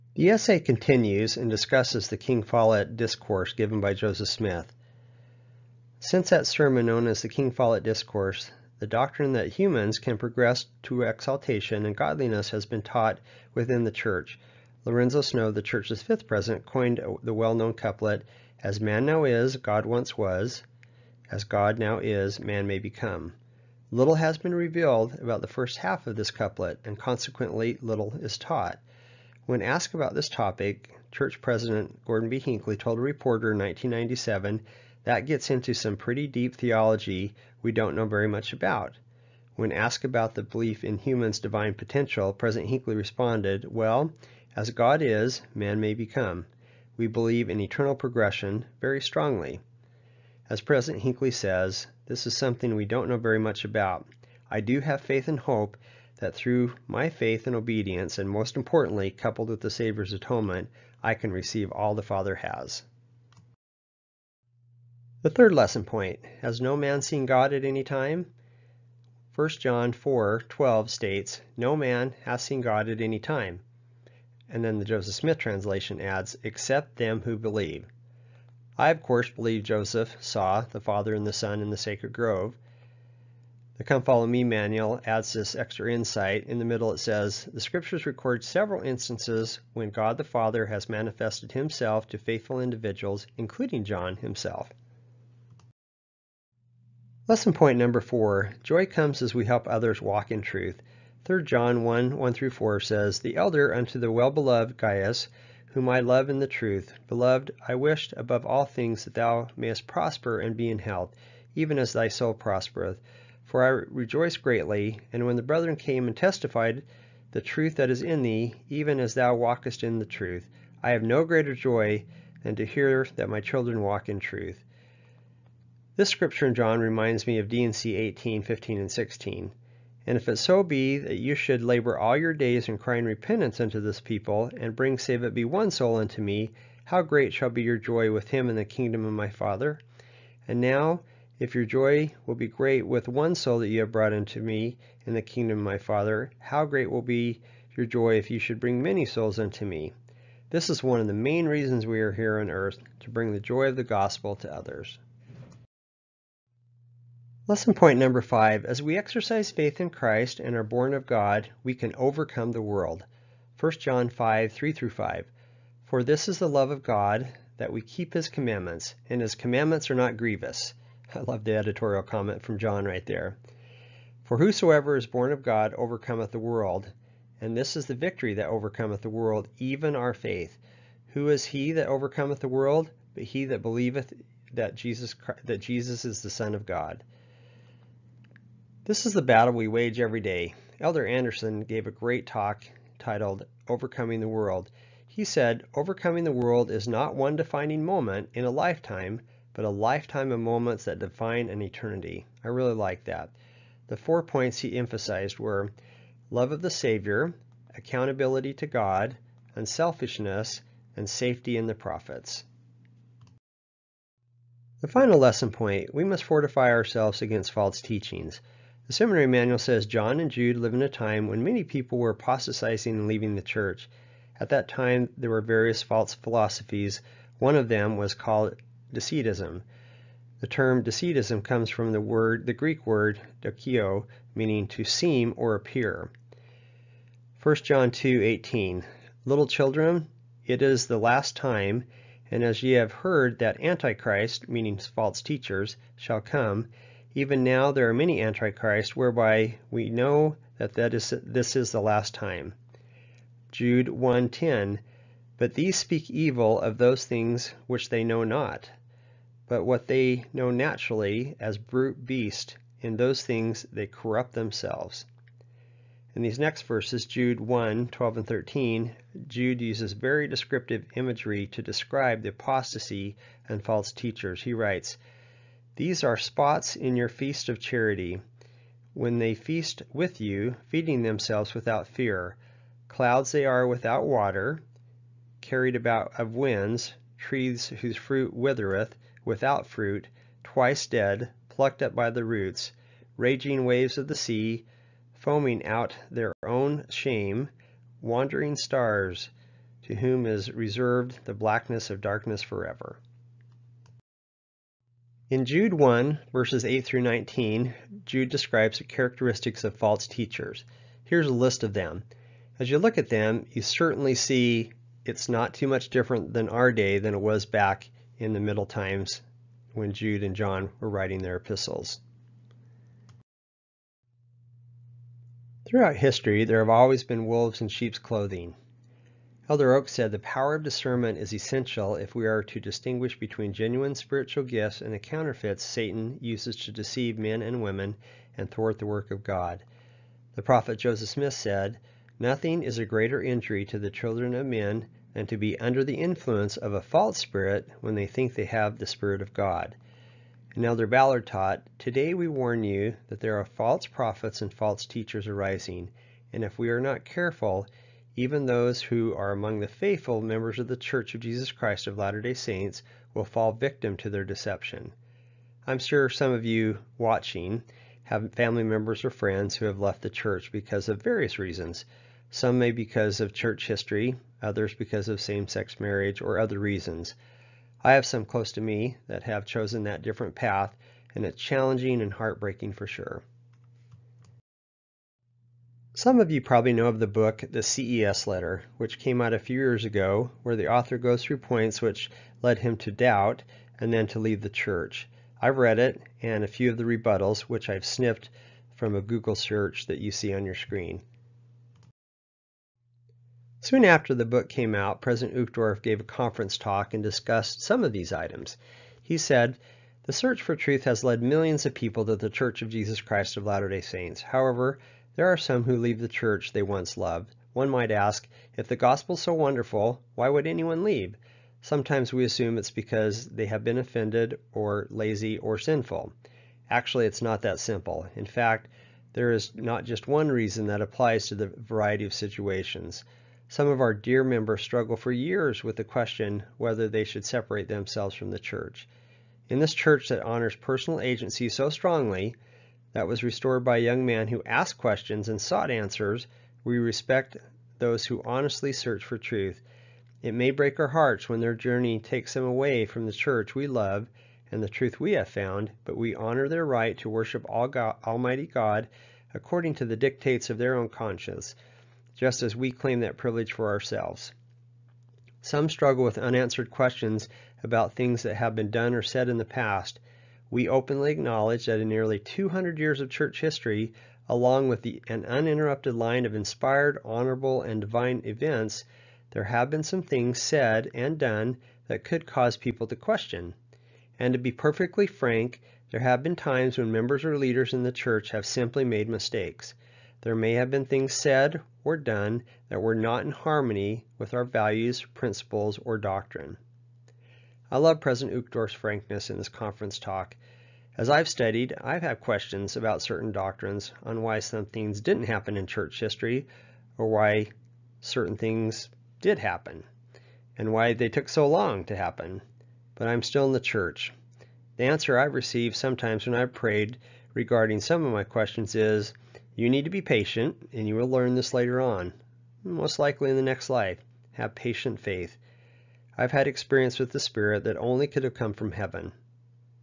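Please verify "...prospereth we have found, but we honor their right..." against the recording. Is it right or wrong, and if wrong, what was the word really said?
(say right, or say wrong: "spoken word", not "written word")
wrong: "truth", not "prospereth".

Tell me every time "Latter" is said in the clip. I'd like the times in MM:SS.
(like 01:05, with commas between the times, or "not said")
06:01, 06:53.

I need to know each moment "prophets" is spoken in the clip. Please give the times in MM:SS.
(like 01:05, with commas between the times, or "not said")
03:31, 05:40, 05:53.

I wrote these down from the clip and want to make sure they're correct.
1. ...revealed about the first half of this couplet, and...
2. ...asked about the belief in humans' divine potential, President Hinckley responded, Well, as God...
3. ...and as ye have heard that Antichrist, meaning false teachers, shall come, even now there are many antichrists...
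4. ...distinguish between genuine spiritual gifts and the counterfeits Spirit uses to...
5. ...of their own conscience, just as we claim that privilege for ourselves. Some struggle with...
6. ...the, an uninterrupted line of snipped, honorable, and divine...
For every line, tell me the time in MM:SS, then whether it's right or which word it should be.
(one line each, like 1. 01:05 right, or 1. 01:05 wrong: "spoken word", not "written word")
1. 00:24 right
2. 00:39 right
3. 04:02 right
4. 05:32 wrong: "Satan", not "Spirit"
5. 07:40 right
6. 07:54 wrong: "inspired", not "snipped".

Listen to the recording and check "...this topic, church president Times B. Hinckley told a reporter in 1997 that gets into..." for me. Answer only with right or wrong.
wrong.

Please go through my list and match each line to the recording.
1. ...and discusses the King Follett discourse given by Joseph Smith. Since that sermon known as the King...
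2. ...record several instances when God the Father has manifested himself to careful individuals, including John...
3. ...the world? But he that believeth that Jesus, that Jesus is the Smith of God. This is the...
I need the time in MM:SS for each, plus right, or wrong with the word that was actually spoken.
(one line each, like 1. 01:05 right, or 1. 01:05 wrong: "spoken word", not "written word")
1. 00:01 right
2. 01:28 wrong: "faithful", not "careful"
3. 03:02 wrong: "Son", not "Smith".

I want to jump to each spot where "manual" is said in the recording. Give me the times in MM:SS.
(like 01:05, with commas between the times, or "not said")
01:24, 03:39.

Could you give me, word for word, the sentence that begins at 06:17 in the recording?
I have some close to me that have chosen that different path, and it's challenging and heartbreaking for sure.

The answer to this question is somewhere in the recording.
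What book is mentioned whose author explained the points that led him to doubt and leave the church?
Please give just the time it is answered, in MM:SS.
06:27.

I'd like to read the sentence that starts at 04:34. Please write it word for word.
He writes, these are spots in your feast of charity.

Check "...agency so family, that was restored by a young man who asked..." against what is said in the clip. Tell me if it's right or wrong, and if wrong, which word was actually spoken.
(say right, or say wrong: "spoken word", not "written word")
wrong: "strongly", not "family".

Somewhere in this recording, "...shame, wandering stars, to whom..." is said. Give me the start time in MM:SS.
04:56.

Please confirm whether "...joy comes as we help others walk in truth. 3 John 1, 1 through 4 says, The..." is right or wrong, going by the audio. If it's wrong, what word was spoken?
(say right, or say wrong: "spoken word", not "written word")
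right.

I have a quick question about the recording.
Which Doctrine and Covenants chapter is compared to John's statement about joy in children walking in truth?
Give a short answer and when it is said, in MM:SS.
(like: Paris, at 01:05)
D&C 18, at 02:07.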